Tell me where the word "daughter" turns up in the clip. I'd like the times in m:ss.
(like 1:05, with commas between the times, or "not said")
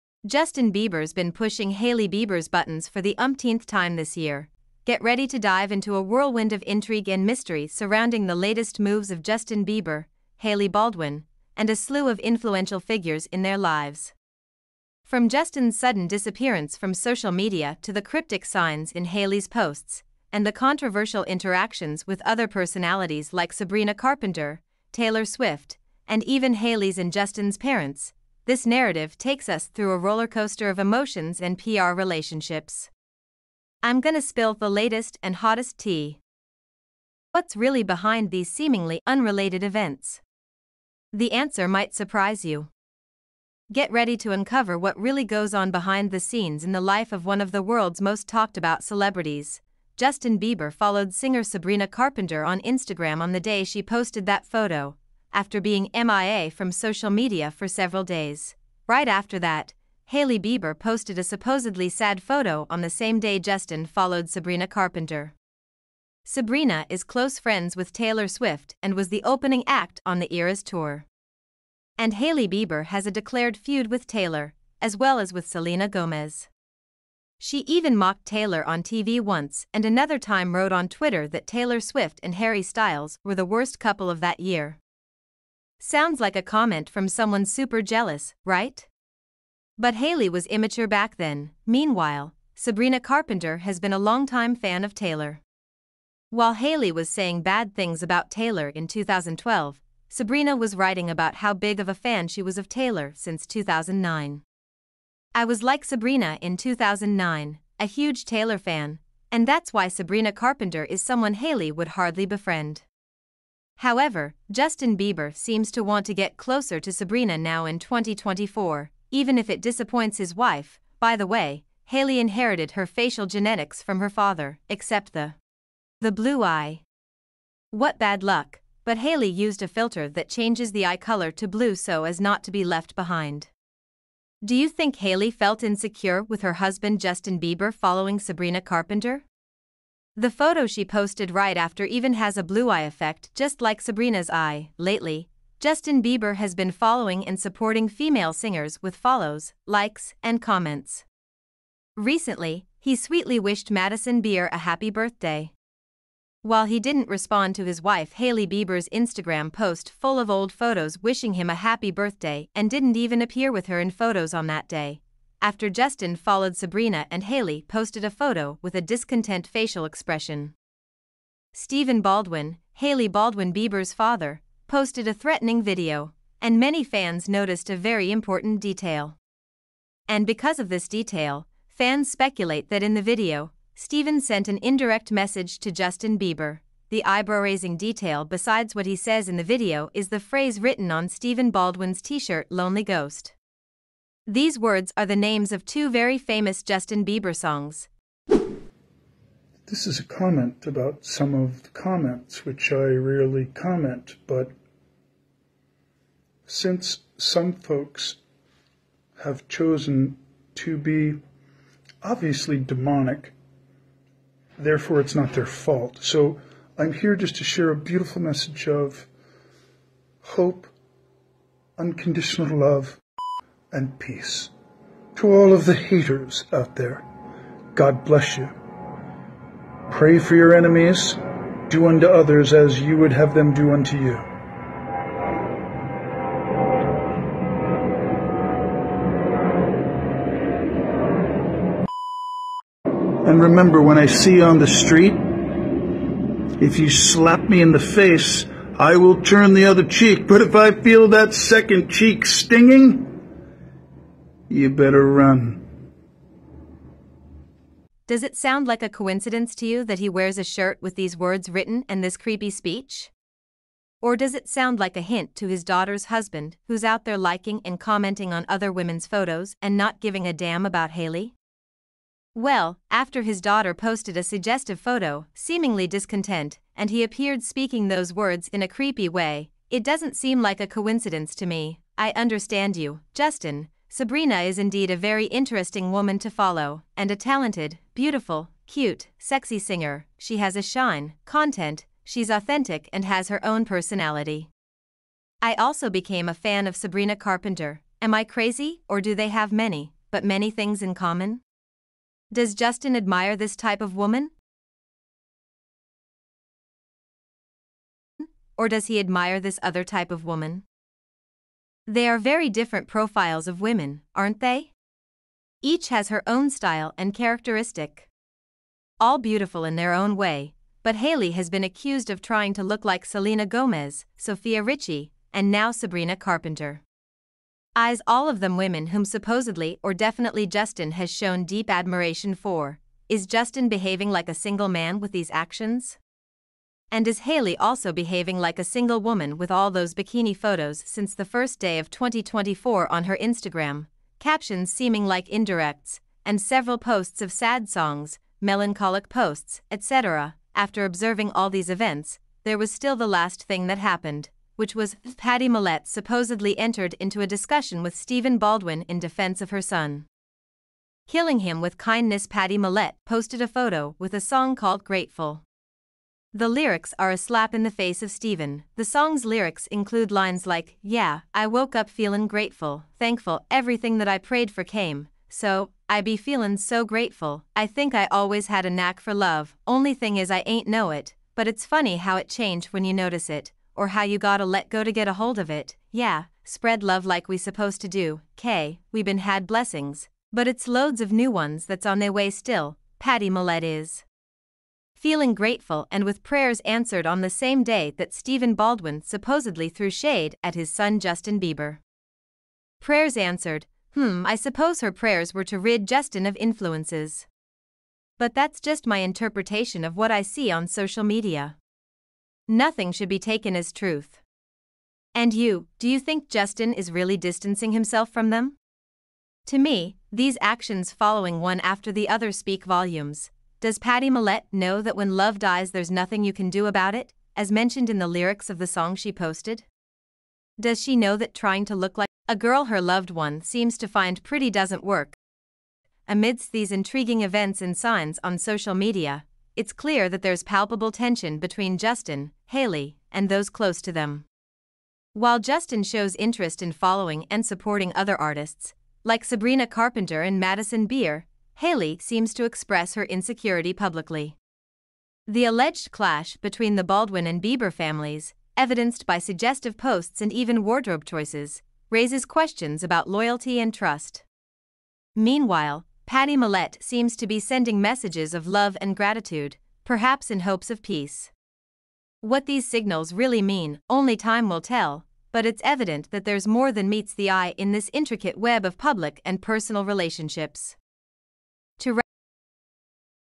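4:25, 4:33.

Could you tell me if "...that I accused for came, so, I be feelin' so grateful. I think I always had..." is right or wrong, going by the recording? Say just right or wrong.
wrong.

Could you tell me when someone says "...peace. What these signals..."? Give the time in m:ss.
7:50.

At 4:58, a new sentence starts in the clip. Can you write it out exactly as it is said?
Am I crazy, or do they have many, but many things in common?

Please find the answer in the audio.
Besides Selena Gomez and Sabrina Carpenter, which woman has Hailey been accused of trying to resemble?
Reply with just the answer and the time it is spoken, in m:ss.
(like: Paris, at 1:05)
Sofia Richie, at 5:24.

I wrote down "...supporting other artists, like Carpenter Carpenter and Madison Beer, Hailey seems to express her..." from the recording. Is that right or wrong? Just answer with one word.
wrong.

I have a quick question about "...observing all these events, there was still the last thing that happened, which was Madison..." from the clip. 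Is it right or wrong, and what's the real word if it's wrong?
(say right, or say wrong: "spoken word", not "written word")
wrong: "Pattie", not "Madison".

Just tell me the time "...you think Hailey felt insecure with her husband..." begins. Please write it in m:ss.
2:14.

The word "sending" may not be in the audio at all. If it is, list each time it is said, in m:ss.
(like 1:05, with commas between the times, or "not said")
7:47.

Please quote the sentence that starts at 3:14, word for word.
These words are the names of two very famous Justin Bieber songs.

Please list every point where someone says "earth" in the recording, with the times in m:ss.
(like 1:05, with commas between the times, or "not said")
not said.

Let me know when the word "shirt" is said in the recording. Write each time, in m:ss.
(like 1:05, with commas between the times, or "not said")
3:12, 4:20.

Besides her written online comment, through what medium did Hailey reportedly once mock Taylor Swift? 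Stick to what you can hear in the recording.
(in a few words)
TV.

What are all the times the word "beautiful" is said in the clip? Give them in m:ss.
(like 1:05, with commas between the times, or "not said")
3:37, 4:47, 5:19.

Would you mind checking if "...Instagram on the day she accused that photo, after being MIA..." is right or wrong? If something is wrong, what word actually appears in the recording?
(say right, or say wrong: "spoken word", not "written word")
wrong: "posted", not "accused".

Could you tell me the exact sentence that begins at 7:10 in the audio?
Does she know that trying to look like a girl her loved one seems to find pretty doesn't work?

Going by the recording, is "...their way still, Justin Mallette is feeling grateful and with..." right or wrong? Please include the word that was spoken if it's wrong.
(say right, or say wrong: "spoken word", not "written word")
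wrong: "Pattie", not "Justin".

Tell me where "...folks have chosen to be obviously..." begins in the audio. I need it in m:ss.
3:27.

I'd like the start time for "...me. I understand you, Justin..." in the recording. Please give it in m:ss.
4:41.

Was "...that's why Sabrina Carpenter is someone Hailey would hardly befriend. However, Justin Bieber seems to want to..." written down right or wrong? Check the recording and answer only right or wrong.
right.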